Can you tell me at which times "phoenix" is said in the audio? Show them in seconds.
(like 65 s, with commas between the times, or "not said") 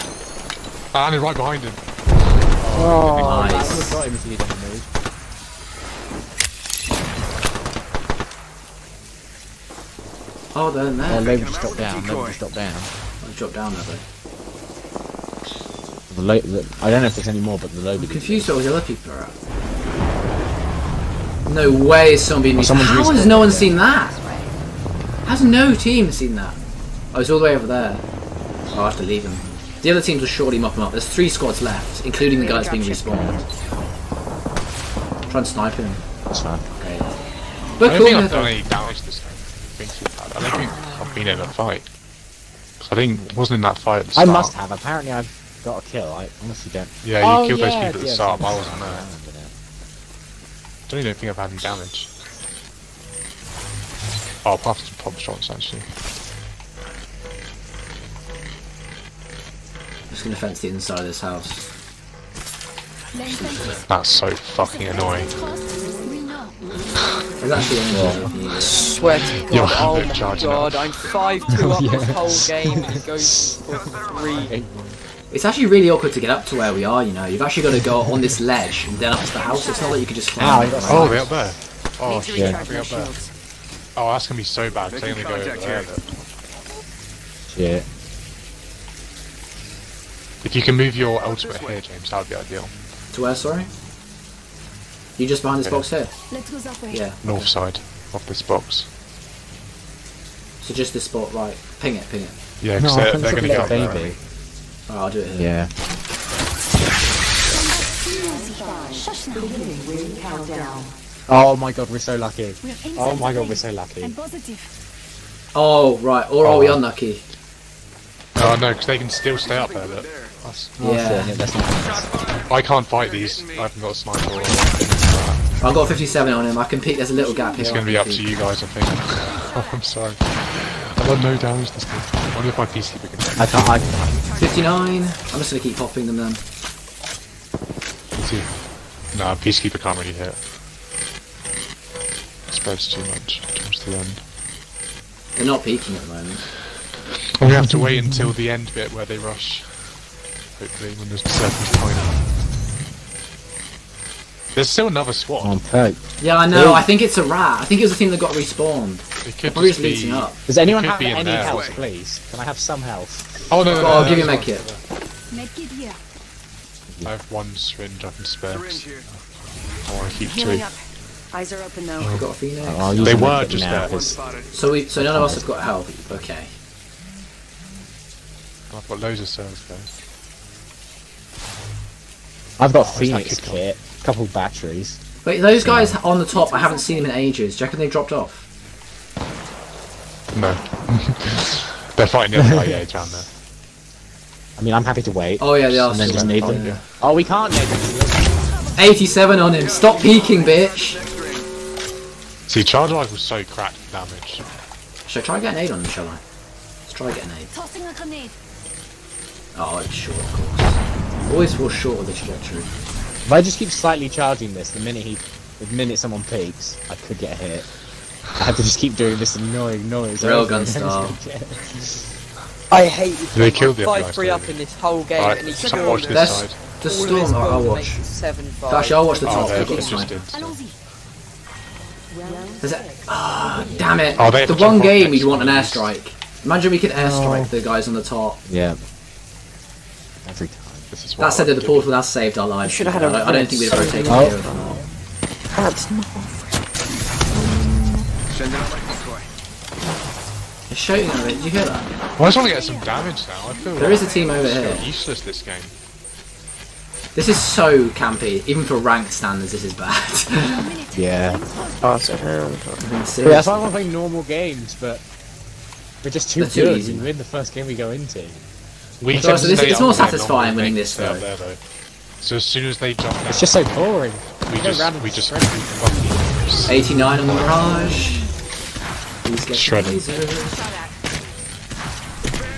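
172 s, 182 s.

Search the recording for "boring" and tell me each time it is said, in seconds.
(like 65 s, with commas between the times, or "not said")
273 s.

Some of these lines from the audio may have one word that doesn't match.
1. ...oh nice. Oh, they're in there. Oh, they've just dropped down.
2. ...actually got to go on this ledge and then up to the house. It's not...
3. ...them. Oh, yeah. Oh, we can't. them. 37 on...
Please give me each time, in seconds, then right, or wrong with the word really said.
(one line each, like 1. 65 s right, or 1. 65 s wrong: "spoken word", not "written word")
1. 3 s right
2. 77 s right
3. 196 s wrong: "87", not "37".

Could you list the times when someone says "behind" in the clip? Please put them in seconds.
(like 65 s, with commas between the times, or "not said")
1 s, 95 s.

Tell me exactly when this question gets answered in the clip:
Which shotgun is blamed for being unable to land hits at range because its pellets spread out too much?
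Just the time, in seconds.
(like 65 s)
139 s.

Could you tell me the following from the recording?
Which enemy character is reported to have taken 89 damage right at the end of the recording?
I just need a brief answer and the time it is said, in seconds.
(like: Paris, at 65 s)
Mirage, at 277 s.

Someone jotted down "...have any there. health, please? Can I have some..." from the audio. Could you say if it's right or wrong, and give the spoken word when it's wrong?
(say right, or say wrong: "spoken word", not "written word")
right.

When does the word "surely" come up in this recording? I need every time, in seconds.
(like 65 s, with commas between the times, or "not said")
30 s.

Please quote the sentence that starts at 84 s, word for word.
I'm going to go over there.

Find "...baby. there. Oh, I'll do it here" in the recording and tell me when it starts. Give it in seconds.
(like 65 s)
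103 s.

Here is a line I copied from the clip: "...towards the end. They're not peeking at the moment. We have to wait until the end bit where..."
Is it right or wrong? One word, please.
right.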